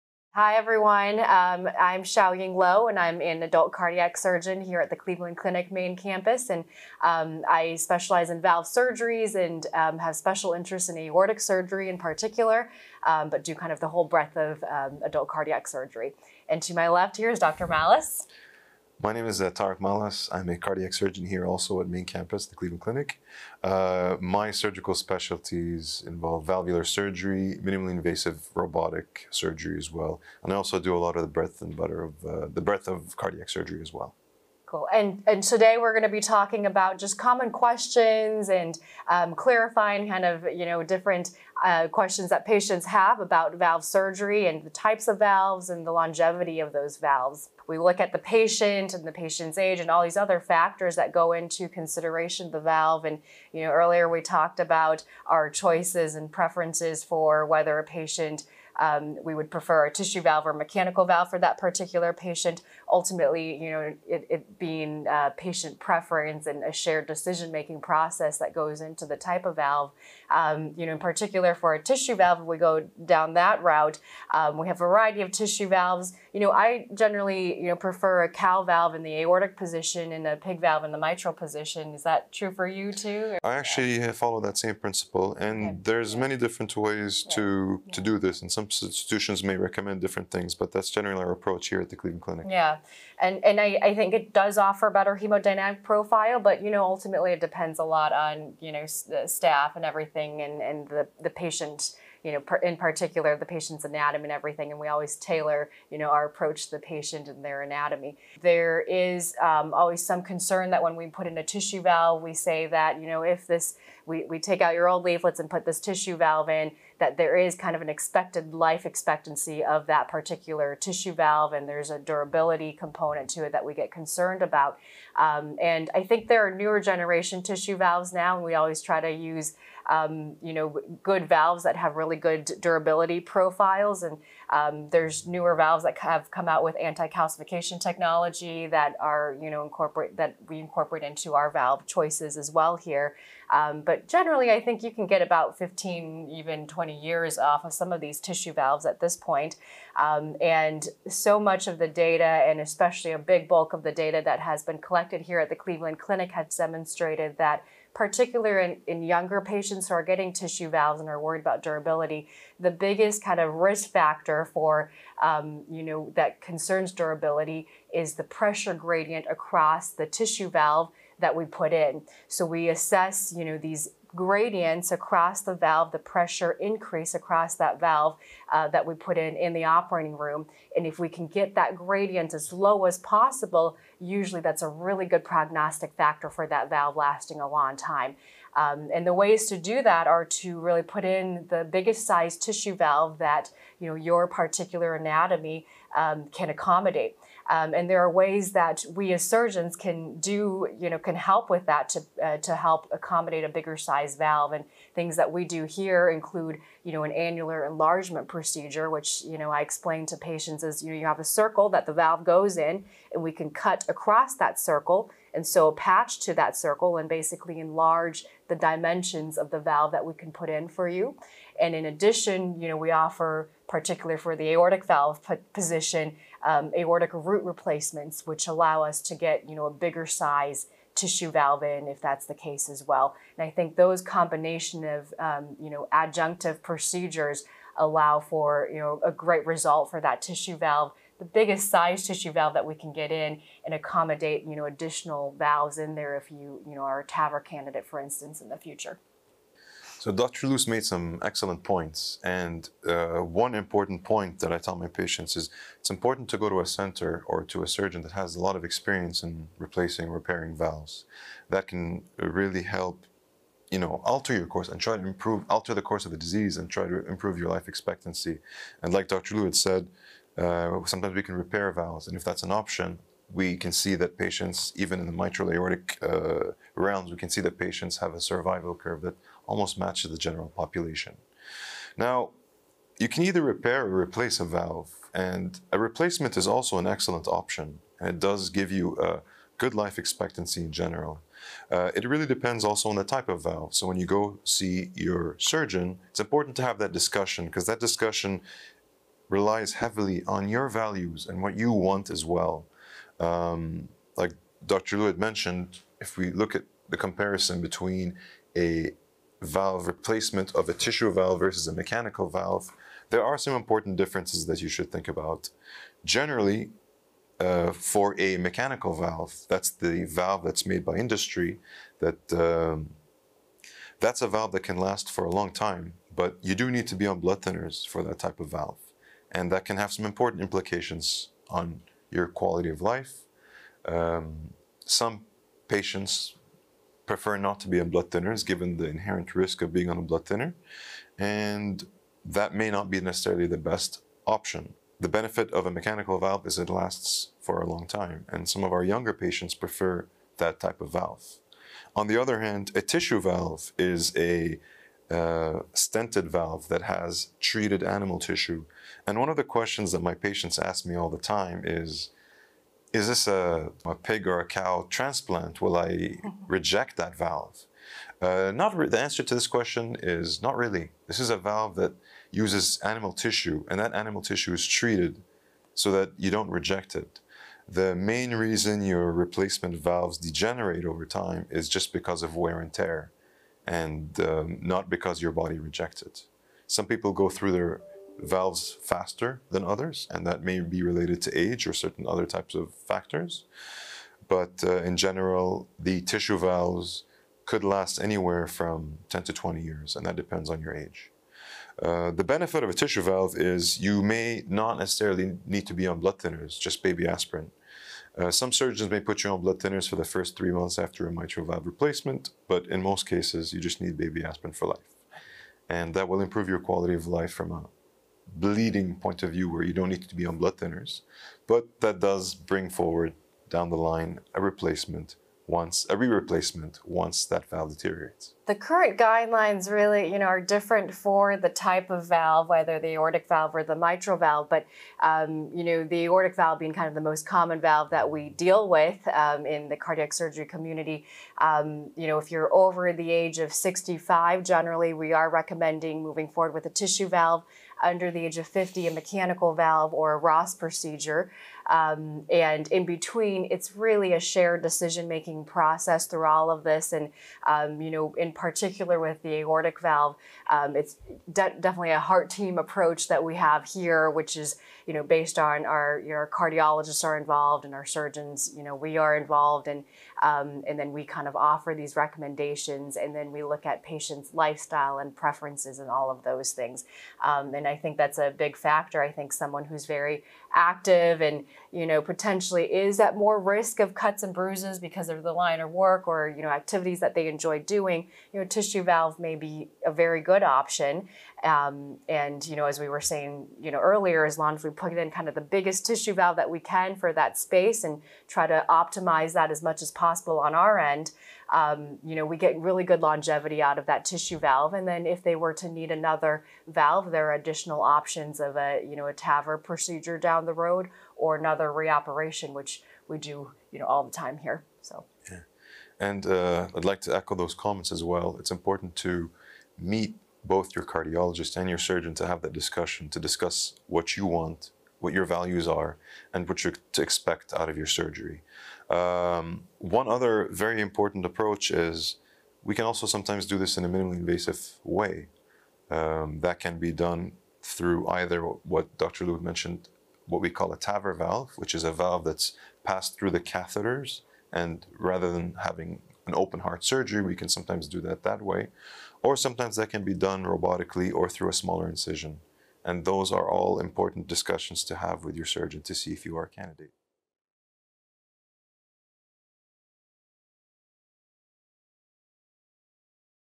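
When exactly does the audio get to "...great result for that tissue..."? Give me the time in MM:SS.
03:59.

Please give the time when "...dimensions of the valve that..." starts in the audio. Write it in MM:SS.
03:38.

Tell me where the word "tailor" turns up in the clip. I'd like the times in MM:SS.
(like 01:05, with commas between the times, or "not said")
01:45.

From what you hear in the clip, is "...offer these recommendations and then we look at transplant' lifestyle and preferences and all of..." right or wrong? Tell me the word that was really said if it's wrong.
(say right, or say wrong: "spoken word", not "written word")
wrong: "patients", not "transplant".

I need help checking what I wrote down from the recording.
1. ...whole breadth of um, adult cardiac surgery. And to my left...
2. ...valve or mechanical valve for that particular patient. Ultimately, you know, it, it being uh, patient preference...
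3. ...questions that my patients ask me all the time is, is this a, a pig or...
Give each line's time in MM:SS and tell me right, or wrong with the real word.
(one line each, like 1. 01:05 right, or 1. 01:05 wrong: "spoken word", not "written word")
1. 00:13 right
2. 01:00 right
3. 05:59 right.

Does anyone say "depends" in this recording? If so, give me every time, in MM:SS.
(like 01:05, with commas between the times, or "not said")
01:37, 04:52, 06:40.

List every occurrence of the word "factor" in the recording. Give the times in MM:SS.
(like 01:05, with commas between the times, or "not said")
00:50, 02:43, 03:05, 06:32, 07:58.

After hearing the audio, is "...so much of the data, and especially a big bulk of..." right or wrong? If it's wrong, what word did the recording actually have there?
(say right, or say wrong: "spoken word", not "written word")
right.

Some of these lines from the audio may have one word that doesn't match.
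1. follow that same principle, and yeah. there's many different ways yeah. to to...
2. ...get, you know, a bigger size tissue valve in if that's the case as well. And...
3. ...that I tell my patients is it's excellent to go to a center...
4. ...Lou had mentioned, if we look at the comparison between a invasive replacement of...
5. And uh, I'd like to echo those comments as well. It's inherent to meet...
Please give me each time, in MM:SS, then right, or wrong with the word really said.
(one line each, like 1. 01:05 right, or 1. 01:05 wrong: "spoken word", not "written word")
1. 01:24 right
2. 03:49 right
3. 04:14 wrong: "important", not "excellent"
4. 05:04 wrong: "valve", not "invasive"
5. 08:35 wrong: "important", not "inherent".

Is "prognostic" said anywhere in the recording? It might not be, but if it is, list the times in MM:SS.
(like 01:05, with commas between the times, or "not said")
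03:05.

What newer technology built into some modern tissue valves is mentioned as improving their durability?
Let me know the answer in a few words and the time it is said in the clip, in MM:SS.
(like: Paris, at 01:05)
anti-calcification technology, at 02:16.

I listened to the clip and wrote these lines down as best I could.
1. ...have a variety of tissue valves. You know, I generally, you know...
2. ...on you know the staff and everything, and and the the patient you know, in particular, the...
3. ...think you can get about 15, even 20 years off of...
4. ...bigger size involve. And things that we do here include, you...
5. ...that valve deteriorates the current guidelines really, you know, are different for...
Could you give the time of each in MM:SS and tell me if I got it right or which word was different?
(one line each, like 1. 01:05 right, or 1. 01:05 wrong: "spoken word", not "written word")
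1. 01:14 right
2. 01:38 right
3. 02:24 right
4. 03:23 wrong: "valve", not "involve"
5. 07:07 right.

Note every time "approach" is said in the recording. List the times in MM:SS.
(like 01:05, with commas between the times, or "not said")
01:31, 01:46, 07:42, 08:51.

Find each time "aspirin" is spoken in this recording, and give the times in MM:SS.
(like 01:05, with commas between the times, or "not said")
06:47, 06:54.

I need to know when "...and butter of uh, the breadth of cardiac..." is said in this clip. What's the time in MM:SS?
00:31.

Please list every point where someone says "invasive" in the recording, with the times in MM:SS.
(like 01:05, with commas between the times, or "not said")
00:27, 08:54.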